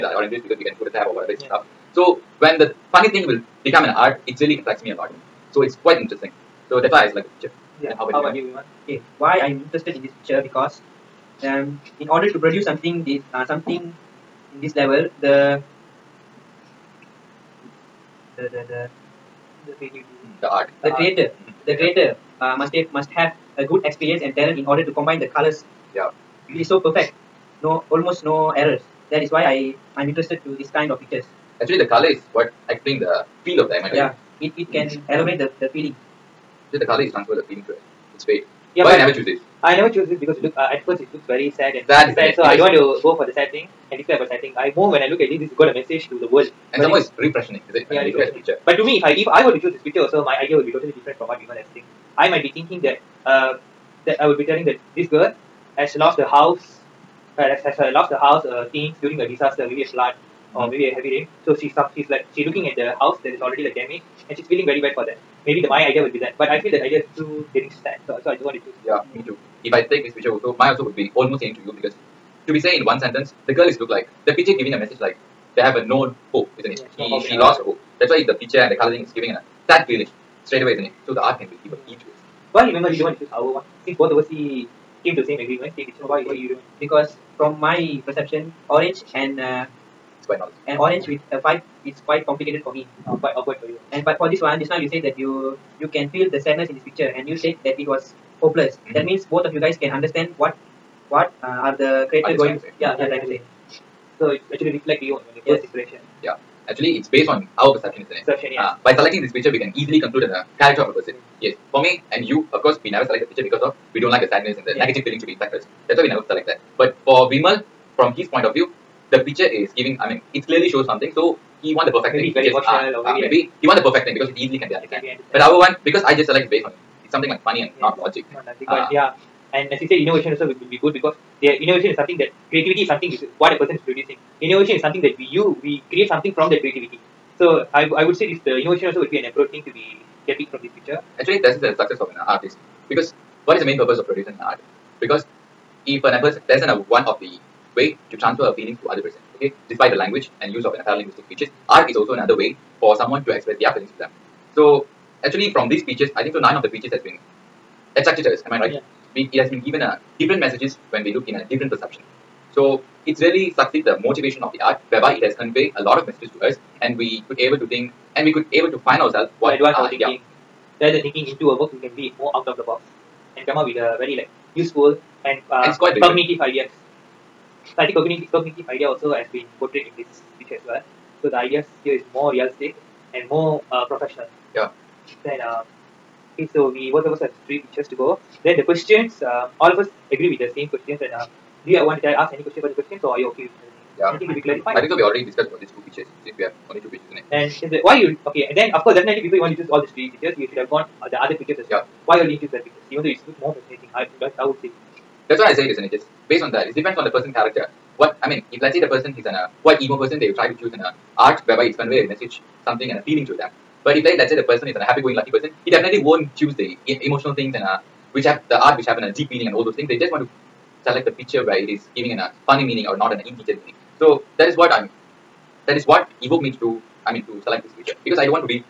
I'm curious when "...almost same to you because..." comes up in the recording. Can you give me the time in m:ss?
1:11.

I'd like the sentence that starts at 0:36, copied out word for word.
So the color is transfer the feeling to it.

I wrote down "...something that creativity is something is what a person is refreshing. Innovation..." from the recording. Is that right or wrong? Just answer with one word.
wrong.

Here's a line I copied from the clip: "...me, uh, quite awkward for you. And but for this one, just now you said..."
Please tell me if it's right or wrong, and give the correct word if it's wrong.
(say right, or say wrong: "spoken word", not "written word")
right.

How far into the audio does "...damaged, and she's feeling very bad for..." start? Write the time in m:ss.
1:03.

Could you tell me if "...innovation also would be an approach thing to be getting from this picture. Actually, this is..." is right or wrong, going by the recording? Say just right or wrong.
right.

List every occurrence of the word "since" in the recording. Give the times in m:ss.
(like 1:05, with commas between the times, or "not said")
1:23, 3:16.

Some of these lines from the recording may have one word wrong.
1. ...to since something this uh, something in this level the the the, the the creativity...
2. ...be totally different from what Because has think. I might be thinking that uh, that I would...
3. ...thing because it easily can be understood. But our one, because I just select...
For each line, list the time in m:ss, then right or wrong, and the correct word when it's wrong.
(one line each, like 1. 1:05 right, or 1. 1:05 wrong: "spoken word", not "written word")
1. 0:12 wrong: "produce", not "since"
2. 0:50 wrong: "Vimal", not "Because"
3. 2:04 right.